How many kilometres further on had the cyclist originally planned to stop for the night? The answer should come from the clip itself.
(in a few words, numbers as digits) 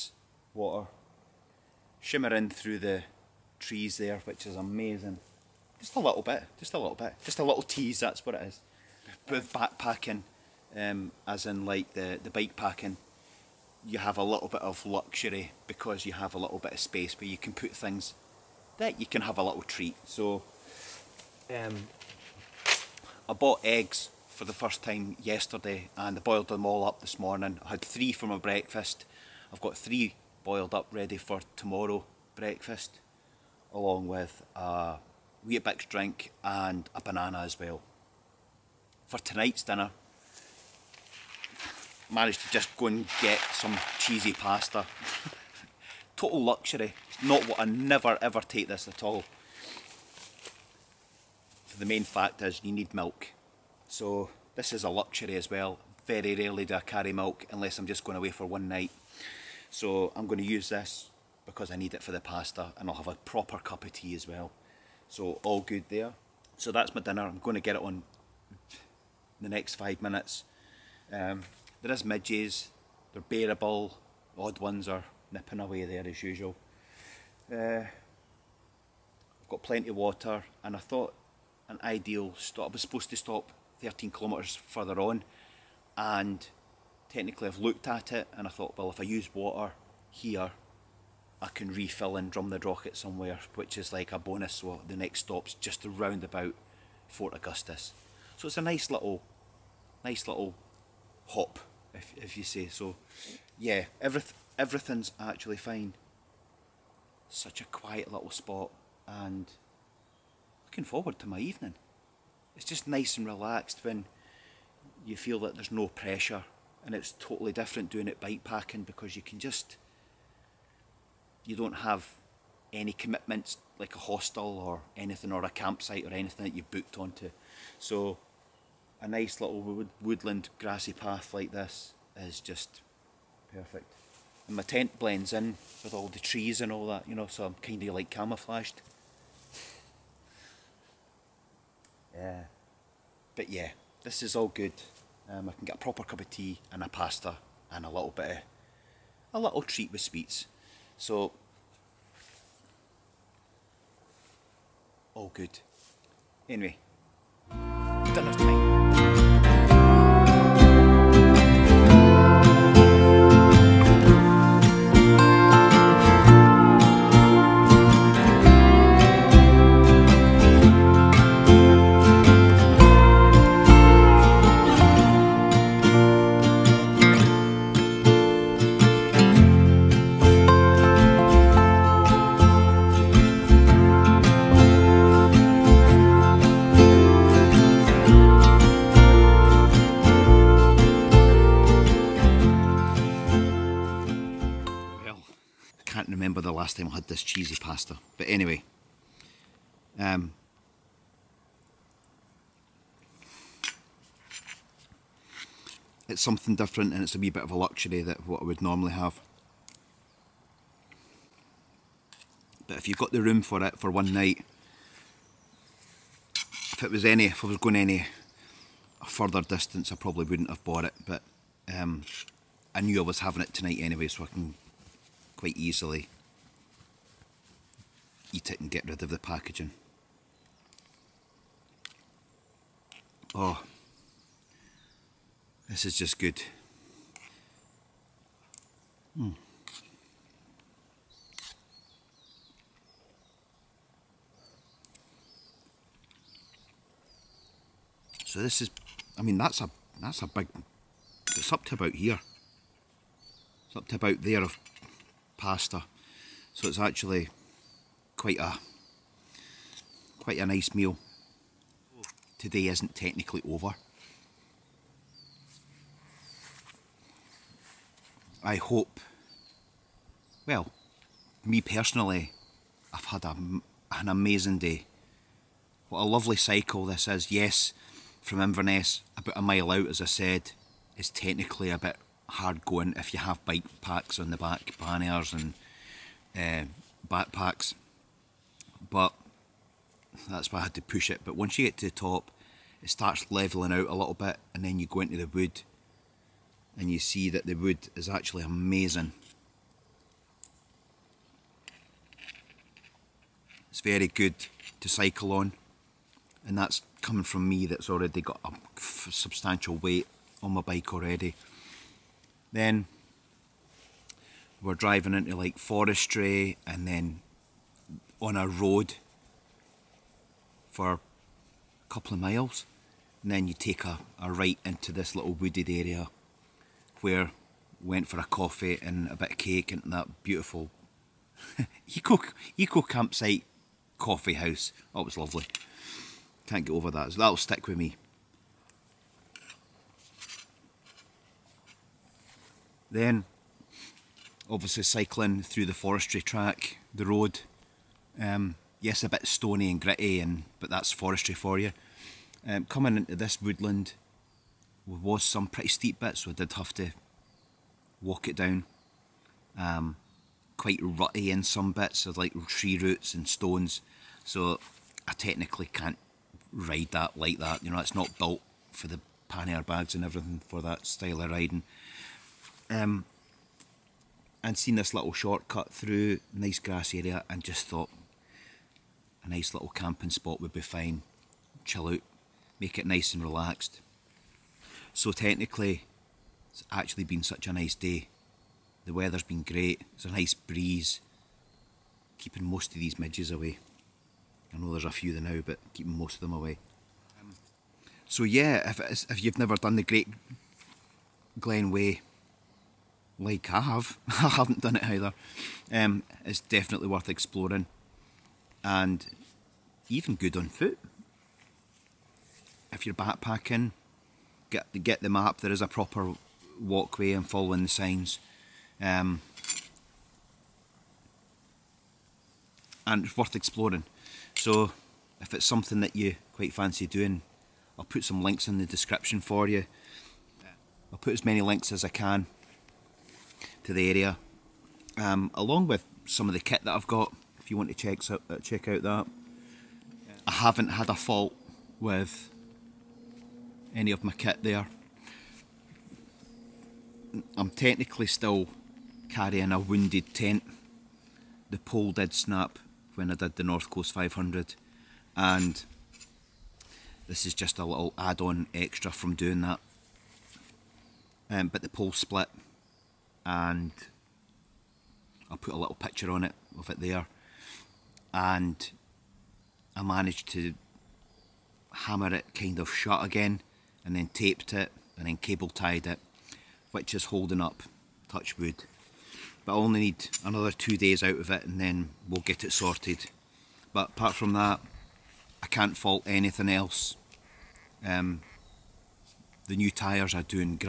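13.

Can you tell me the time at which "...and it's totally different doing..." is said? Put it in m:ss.
1:56.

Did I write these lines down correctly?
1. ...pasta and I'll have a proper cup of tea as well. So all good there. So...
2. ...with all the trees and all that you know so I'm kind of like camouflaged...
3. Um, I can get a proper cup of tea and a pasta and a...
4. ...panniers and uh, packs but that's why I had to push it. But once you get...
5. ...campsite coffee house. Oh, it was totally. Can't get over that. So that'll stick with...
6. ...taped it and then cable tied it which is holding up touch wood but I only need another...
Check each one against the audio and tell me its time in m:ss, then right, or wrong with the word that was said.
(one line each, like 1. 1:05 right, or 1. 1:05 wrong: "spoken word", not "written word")
1. 1:02 right
2. 2:15 right
3. 2:25 right
4. 4:44 wrong: "backpacks", not "packs"
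5. 5:32 wrong: "lovely", not "totally"
6. 7:54 right.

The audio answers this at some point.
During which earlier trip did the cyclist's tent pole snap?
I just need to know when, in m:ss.
7:33.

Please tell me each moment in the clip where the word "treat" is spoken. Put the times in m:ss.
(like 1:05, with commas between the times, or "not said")
0:19, 2:29.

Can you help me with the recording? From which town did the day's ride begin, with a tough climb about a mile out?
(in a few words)
Inverness.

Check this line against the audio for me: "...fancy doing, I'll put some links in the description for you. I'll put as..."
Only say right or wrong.
right.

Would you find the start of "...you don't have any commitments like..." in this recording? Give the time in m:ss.
2:01.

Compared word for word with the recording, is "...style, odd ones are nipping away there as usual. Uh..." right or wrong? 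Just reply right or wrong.
wrong.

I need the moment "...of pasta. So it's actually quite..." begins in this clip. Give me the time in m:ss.
4:14.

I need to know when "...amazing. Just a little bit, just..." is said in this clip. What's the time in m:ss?
0:04.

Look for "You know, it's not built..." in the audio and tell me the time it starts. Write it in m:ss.
6:07.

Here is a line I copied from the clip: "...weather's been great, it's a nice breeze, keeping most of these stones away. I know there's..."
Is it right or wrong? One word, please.
wrong.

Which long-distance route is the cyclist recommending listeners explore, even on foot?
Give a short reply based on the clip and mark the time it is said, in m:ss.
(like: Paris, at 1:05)
Great Glen Way, at 6:39.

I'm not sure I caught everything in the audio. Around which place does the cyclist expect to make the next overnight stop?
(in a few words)
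Fort Augustus.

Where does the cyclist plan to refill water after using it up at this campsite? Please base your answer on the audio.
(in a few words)
Drumnadrochit.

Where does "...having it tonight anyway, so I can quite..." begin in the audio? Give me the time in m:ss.
3:43.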